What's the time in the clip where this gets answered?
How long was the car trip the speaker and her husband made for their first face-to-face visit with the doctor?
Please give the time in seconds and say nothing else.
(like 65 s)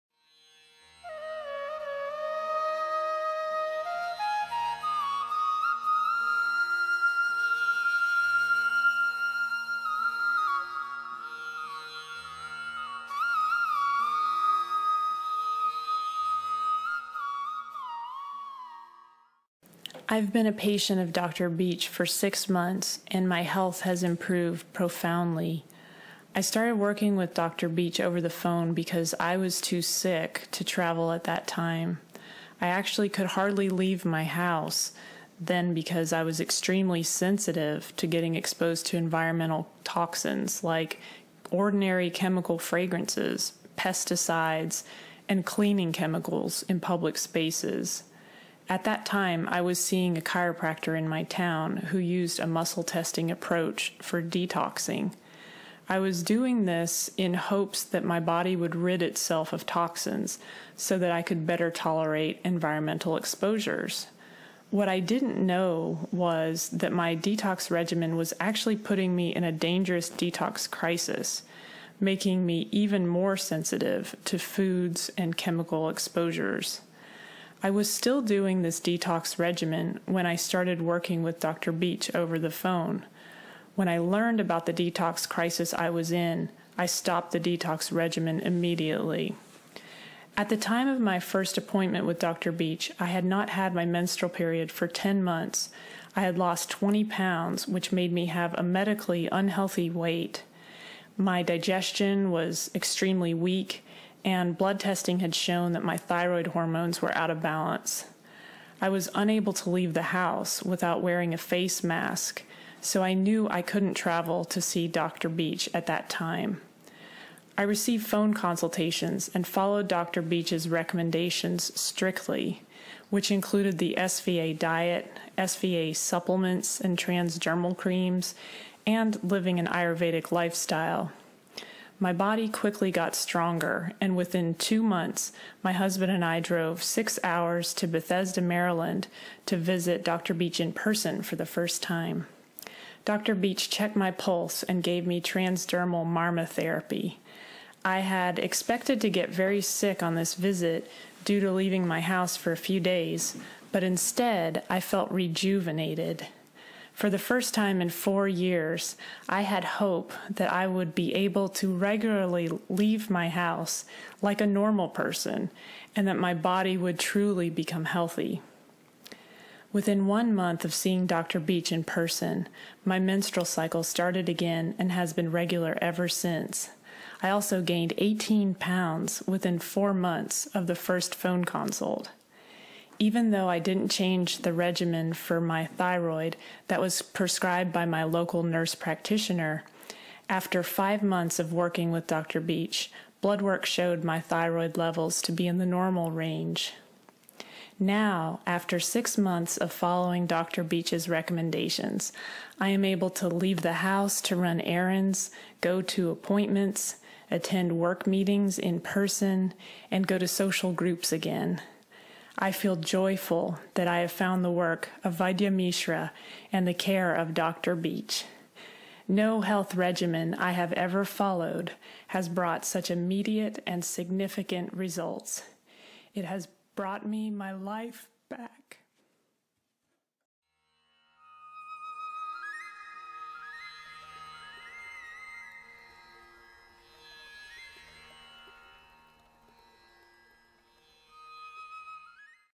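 136 s.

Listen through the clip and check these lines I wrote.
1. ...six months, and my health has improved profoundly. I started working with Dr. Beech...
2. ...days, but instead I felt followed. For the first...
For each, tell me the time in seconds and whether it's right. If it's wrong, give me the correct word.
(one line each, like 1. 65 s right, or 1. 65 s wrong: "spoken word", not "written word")
1. 22 s right
2. 152 s wrong: "rejuvenated", not "followed".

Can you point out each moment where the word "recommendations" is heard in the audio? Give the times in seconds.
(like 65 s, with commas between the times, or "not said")
120 s, 201 s.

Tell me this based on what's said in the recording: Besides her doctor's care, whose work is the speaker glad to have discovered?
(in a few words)
Vaidya Mishra.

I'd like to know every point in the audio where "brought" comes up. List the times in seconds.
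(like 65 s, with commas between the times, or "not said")
222 s, 226 s.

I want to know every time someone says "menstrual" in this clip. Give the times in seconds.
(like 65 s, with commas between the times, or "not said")
93 s, 172 s.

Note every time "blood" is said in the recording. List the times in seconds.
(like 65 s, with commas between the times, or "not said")
104 s, 193 s.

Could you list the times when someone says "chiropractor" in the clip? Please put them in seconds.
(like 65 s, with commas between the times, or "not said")
50 s.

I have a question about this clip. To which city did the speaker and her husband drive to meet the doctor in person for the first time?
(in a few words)
Bethesda, Maryland.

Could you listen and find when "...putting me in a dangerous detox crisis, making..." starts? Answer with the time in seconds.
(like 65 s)
68 s.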